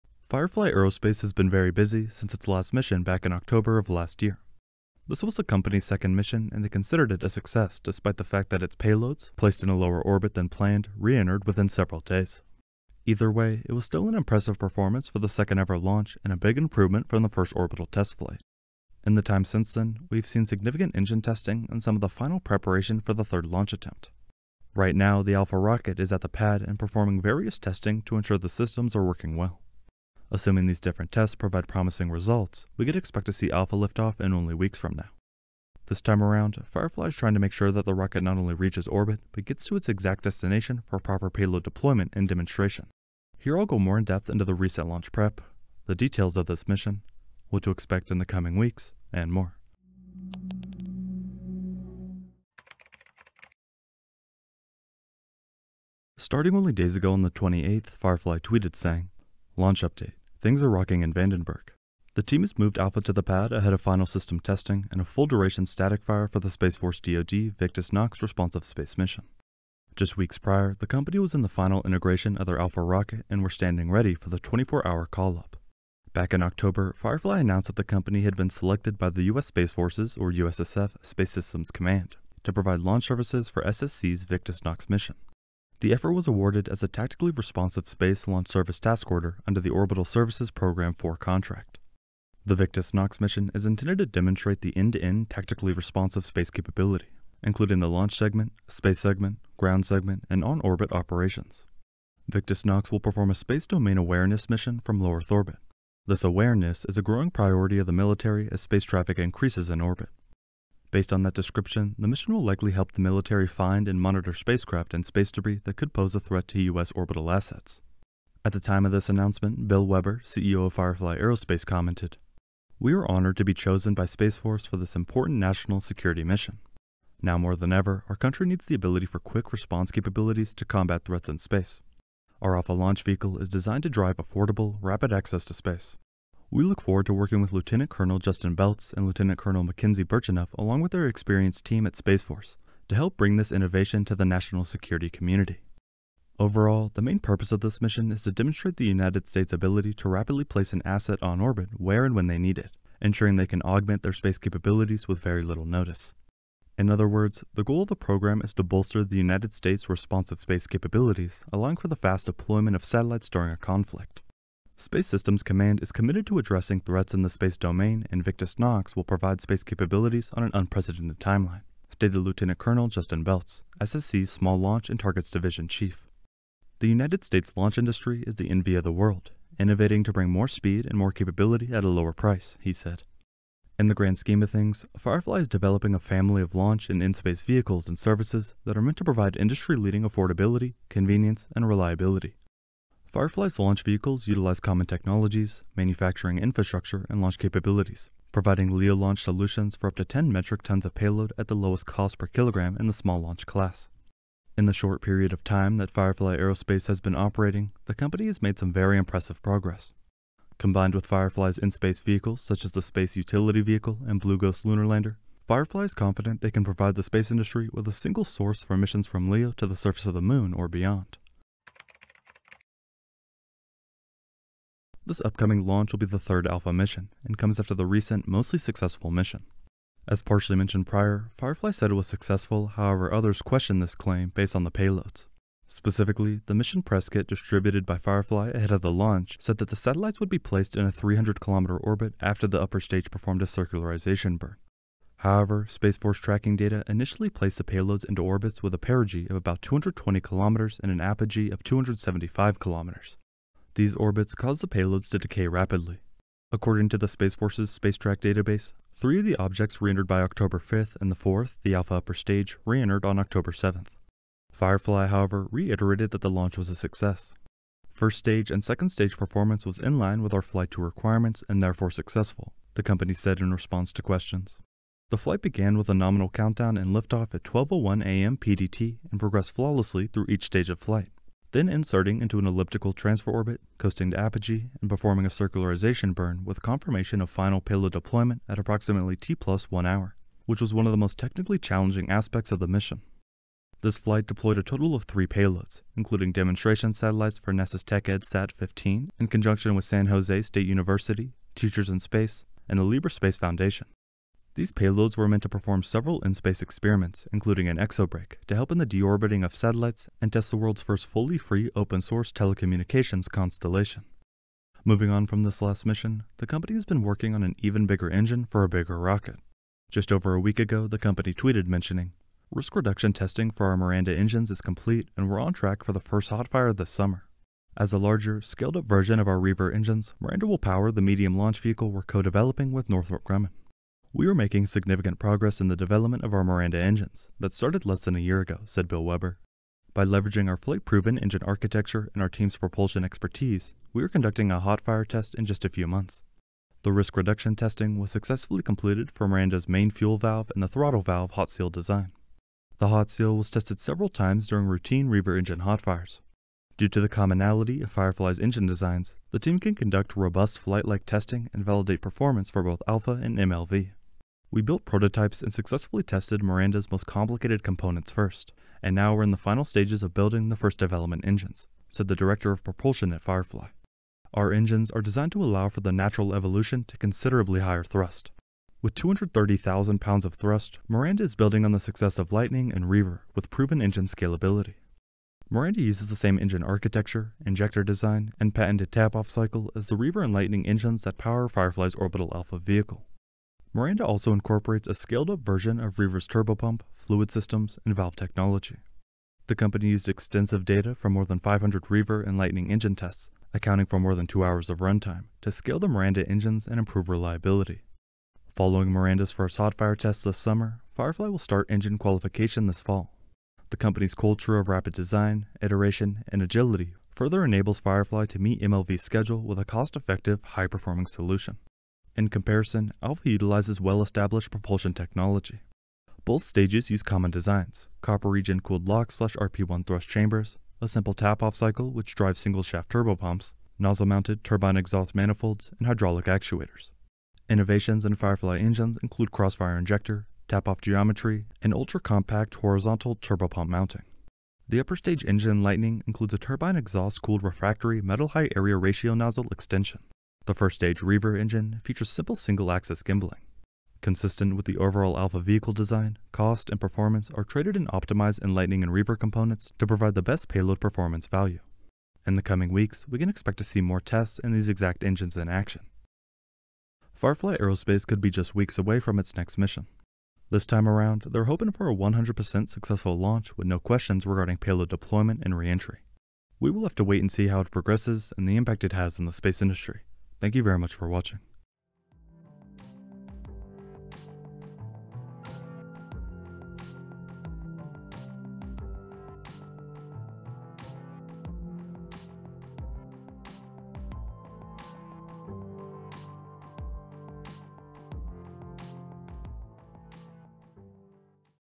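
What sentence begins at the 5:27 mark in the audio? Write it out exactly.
As a larger, scaled-up version of our Reaver engines, Miranda will power the medium launch vehicle we're co-developing with Northrop Grumman.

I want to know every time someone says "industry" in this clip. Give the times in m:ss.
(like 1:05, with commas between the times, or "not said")
2:57, 3:09, 3:37, 7:59.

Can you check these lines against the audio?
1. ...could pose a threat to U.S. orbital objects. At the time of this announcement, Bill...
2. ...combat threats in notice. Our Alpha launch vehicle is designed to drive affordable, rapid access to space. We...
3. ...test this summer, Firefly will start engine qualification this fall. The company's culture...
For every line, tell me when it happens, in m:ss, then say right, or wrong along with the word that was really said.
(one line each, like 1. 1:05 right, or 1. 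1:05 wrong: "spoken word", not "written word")
1. 1:55 wrong: "assets", not "objects"
2. 2:10 wrong: "space", not "notice"
3. 6:49 right.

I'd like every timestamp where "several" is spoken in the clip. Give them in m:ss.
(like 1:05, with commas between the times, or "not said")
0:11, 5:05, 5:53.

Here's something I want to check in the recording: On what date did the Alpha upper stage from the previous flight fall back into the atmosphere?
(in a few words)
October 7th.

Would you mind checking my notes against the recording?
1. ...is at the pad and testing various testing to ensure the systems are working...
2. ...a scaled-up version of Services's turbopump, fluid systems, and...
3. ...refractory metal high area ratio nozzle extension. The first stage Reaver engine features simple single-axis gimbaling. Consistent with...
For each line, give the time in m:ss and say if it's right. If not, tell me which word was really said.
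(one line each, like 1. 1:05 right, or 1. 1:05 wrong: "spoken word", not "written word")
1. 0:25 wrong: "performing", not "testing"
2. 6:34 wrong: "Reaver", not "Services"
3. 7:27 right.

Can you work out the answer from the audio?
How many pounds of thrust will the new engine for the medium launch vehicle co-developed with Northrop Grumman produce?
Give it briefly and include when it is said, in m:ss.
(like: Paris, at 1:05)
230,000, at 6:18.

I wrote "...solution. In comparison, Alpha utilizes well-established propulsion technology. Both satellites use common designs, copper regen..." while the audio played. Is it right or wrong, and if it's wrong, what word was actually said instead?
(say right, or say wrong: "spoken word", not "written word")
wrong: "stages", not "satellites".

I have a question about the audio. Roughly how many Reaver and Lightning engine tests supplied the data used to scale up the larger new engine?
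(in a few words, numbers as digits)
more than 500.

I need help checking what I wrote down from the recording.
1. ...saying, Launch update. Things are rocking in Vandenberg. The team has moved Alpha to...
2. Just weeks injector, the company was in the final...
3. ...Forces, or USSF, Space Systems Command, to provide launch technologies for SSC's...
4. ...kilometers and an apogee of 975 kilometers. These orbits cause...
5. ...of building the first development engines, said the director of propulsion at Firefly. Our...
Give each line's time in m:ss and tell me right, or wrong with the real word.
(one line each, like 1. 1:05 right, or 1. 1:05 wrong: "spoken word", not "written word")
1. 0:58 right
2. 1:09 wrong: "prior", not "injector"
3. 1:19 wrong: "services", not "technologies"
4. 4:10 wrong: "275", not "975"
5. 6:10 right.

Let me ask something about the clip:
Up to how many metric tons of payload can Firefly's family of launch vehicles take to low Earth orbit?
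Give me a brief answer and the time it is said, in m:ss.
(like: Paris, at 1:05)
10, at 3:20.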